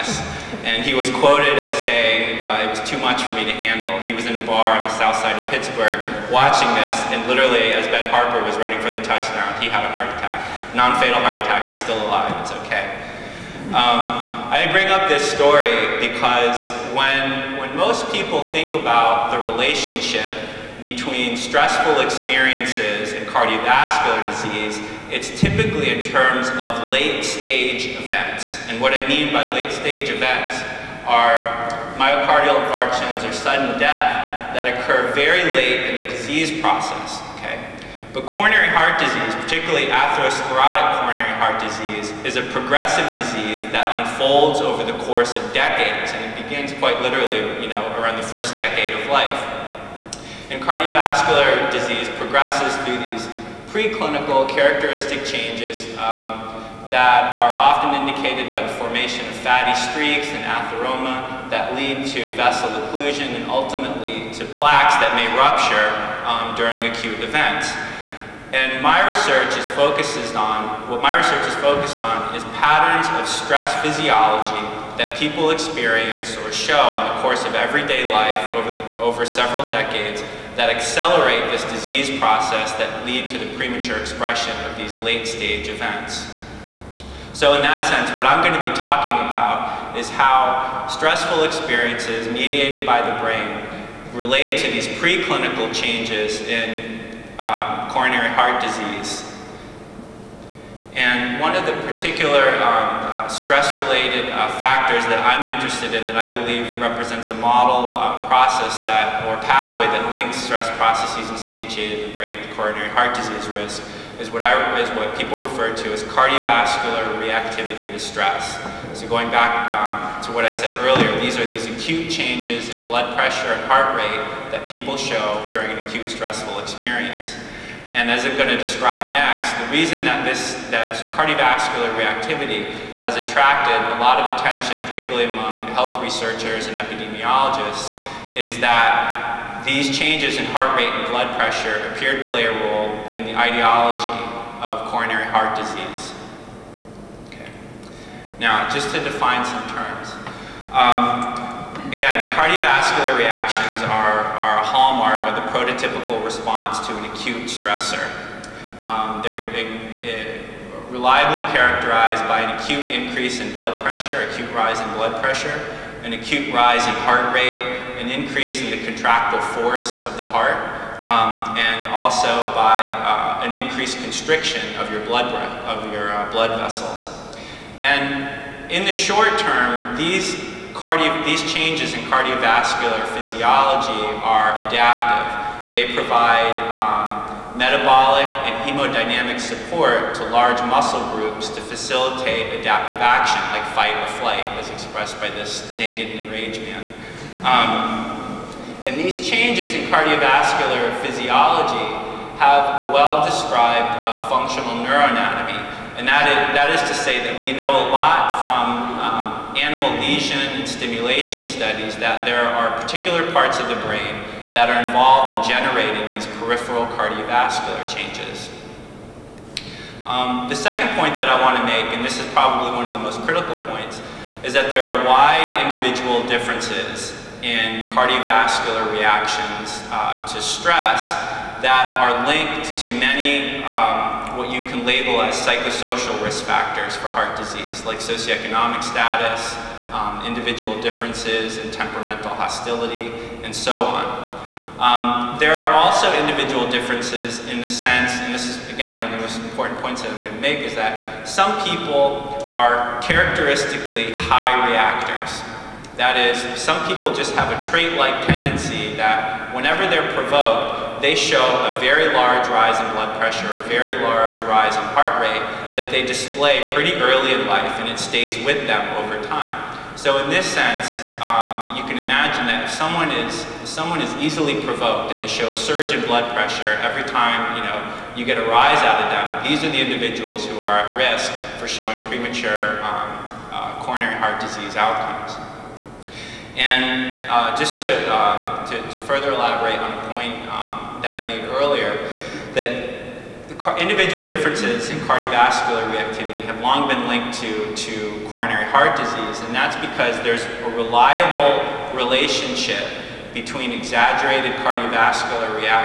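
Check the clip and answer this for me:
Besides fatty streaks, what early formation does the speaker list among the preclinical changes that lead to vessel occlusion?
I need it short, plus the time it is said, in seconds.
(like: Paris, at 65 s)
atheroma, at 60 s.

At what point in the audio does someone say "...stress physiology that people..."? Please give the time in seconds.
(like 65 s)
73 s.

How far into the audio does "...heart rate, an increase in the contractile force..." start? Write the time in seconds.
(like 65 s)
167 s.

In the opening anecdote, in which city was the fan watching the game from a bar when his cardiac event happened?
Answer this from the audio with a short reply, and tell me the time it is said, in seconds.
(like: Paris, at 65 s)
Pittsburgh, at 5 s.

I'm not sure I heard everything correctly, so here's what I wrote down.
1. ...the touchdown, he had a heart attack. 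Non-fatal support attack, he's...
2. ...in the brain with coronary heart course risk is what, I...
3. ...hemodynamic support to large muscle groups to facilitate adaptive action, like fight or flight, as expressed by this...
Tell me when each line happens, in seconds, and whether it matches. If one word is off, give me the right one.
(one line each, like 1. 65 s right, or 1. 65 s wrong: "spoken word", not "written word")
1. 8 s wrong: "heart", not "support"
2. 112 s wrong: "disease", not "course"
3. 188 s right.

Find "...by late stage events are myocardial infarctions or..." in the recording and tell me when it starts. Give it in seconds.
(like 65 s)
29 s.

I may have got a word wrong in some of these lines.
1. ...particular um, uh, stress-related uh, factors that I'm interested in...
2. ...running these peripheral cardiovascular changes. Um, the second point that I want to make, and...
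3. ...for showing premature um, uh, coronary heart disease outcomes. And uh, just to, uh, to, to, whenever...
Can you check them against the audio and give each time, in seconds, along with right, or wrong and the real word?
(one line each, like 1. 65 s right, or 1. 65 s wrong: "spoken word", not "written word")
1. 101 s right
2. 215 s wrong: "generating", not "running"
3. 281 s wrong: "further", not "whenever".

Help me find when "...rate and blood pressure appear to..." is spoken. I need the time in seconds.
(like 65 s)
140 s.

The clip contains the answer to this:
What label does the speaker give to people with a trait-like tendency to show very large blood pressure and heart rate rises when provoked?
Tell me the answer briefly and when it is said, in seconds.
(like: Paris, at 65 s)
high reactors, at 254 s.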